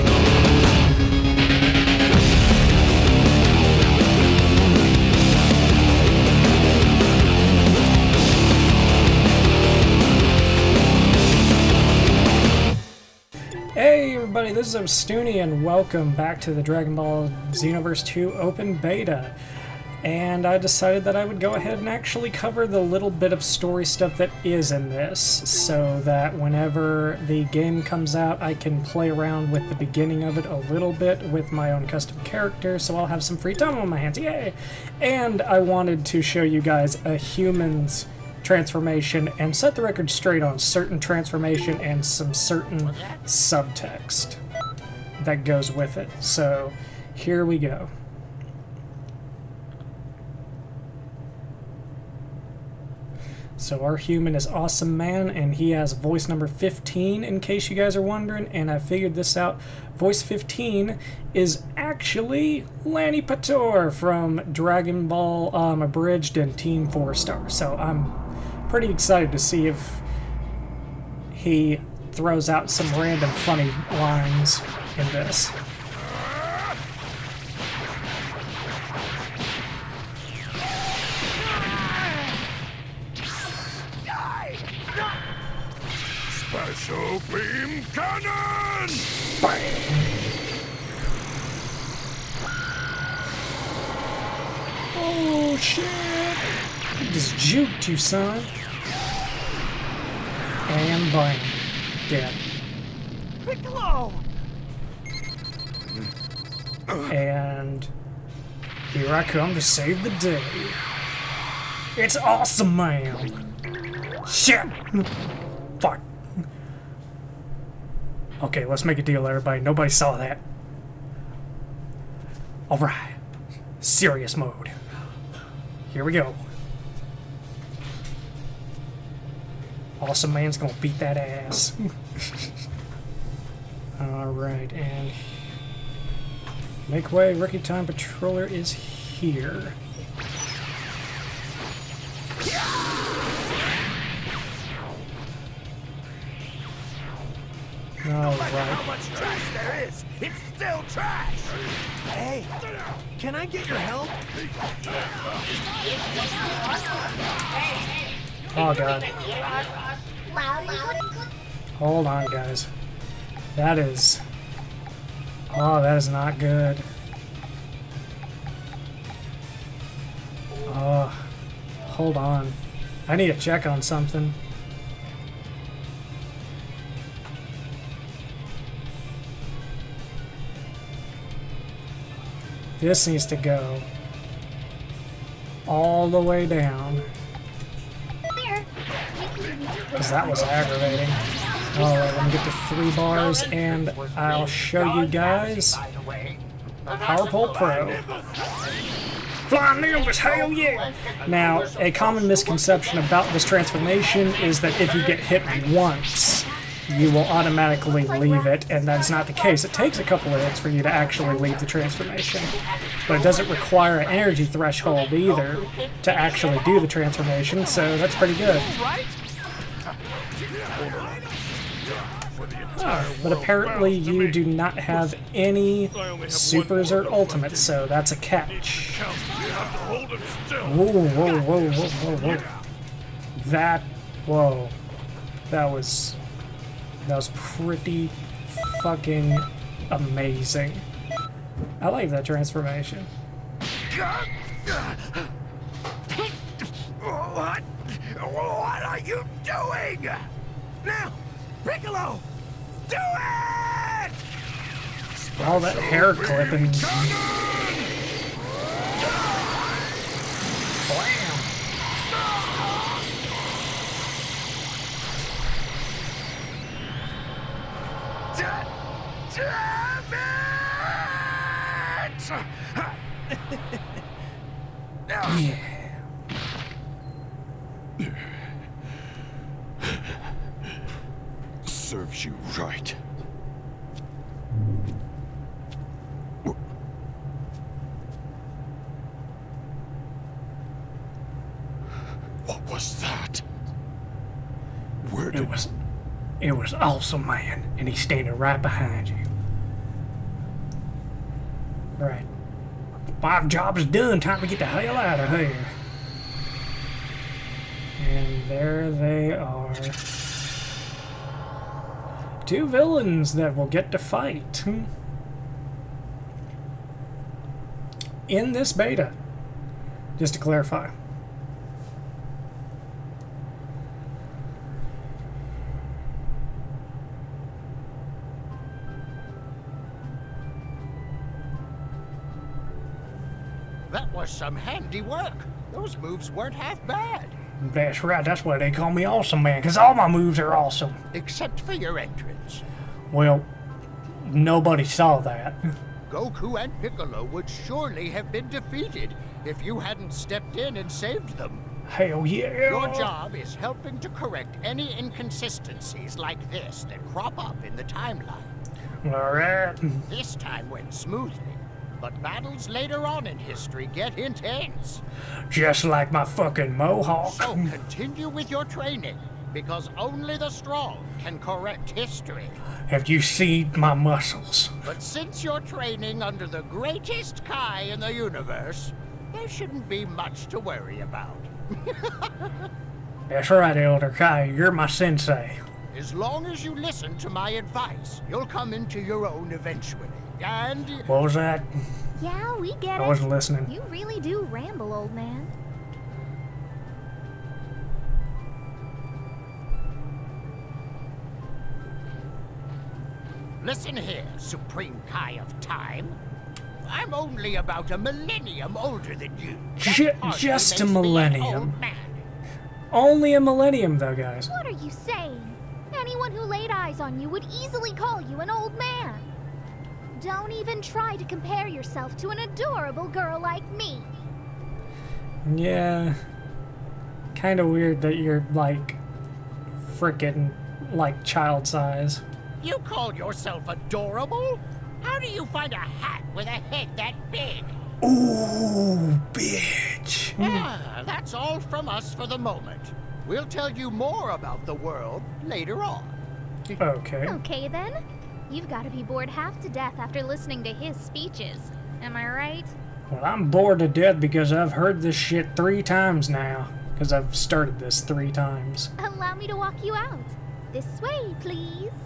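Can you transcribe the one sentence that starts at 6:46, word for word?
I'm only about a millennium older than you.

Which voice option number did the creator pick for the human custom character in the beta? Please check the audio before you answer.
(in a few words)
15.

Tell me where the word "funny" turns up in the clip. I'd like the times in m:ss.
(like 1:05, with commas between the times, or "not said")
1:13.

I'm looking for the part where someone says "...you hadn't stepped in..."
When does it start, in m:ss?
5:49.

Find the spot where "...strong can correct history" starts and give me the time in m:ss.
6:10.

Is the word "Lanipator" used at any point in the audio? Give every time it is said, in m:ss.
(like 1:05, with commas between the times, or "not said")
1:02.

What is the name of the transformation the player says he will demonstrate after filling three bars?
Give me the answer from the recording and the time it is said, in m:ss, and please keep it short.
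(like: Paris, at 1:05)
Power Pole Pro, at 3:16.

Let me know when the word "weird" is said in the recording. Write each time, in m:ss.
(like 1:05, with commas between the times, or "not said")
7:07.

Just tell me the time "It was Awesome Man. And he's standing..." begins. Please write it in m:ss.
4:56.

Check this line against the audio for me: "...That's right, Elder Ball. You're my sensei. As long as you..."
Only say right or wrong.
wrong.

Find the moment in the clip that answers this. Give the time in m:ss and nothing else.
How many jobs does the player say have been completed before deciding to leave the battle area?
5:03.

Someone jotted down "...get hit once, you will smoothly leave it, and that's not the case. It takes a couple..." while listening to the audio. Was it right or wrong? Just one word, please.
wrong.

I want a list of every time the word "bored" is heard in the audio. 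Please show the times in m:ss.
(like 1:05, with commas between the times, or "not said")
7:29, 7:33.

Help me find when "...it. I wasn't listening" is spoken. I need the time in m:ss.
6:33.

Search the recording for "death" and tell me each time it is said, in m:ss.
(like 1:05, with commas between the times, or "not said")
7:29, 7:33.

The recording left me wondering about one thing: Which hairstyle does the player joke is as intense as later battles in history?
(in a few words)
mohawk.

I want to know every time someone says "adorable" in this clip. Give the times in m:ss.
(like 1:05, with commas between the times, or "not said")
7:02, 7:13.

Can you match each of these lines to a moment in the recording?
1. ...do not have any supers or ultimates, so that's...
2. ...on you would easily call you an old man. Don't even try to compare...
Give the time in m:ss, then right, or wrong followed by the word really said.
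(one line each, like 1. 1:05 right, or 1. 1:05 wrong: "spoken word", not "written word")
1. 3:44 right
2. 6:56 right.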